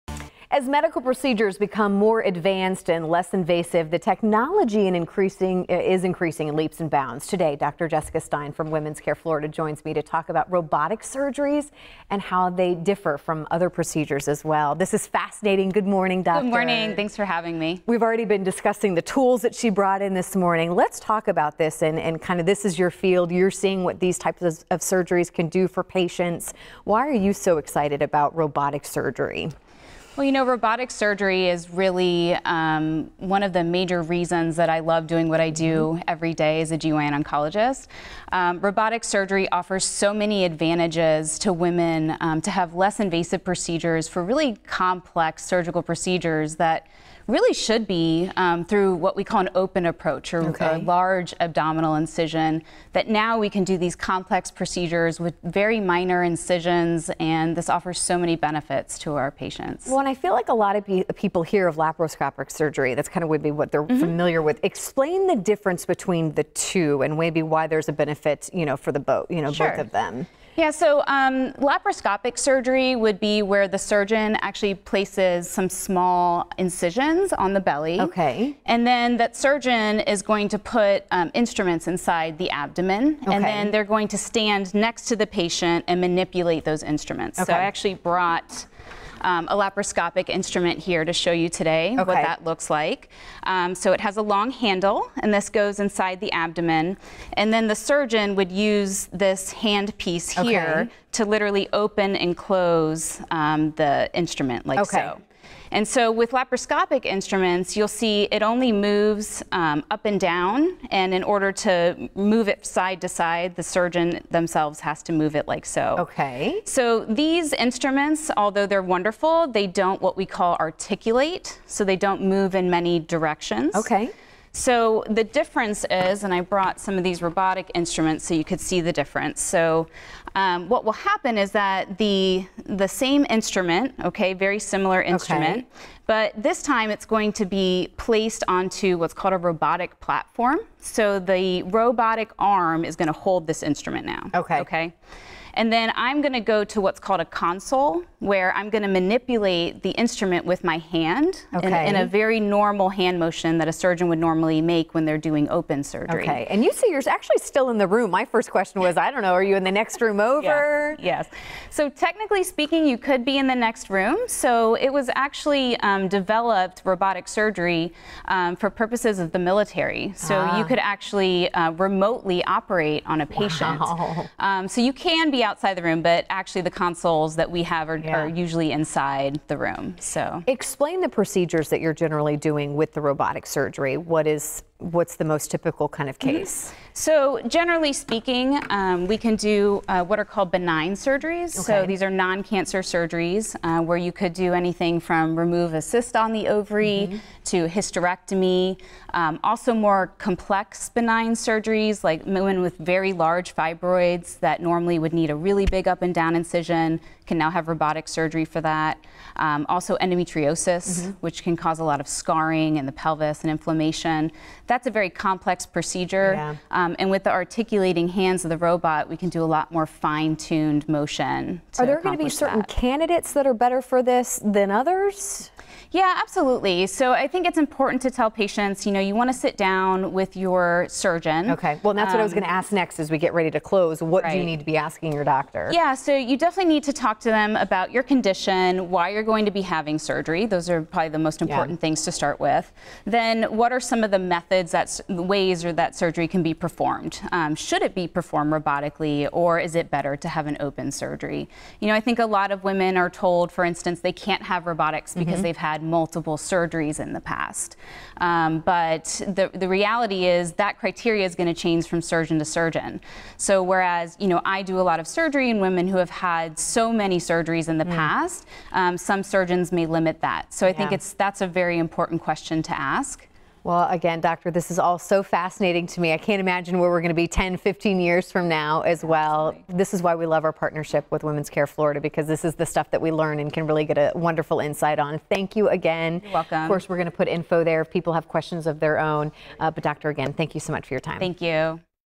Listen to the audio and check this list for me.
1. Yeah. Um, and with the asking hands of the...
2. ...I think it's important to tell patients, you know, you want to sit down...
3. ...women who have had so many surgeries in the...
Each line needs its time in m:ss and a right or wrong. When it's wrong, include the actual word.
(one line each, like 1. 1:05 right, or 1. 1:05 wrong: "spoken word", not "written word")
1. 3:36 wrong: "articulating", not "asking"
2. 3:47 right
3. 4:25 right.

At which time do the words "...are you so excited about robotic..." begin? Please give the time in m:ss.
0:27.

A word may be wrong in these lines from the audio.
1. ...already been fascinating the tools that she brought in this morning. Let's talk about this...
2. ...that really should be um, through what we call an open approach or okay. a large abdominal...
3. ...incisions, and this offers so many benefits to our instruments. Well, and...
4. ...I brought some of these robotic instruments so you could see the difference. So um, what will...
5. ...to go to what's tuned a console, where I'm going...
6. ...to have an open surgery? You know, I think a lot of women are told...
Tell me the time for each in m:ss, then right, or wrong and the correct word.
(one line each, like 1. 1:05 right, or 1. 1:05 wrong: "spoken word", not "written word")
1. 0:18 wrong: "discussing", not "fascinating"
2. 0:46 right
3. 0:56 wrong: "patients", not "instruments"
4. 2:06 right
5. 2:26 wrong: "called", not "tuned"
6. 4:10 right.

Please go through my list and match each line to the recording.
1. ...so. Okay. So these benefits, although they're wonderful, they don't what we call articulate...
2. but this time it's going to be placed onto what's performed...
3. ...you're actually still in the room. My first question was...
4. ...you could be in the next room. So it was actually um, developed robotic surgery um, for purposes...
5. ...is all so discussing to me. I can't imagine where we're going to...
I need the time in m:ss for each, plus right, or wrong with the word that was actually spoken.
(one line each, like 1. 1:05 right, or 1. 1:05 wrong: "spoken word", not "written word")
1. 1:55 wrong: "instruments", not "benefits"
2. 2:16 wrong: "called", not "performed"
3. 2:36 right
4. 2:42 right
5. 4:34 wrong: "fascinating", not "discussing".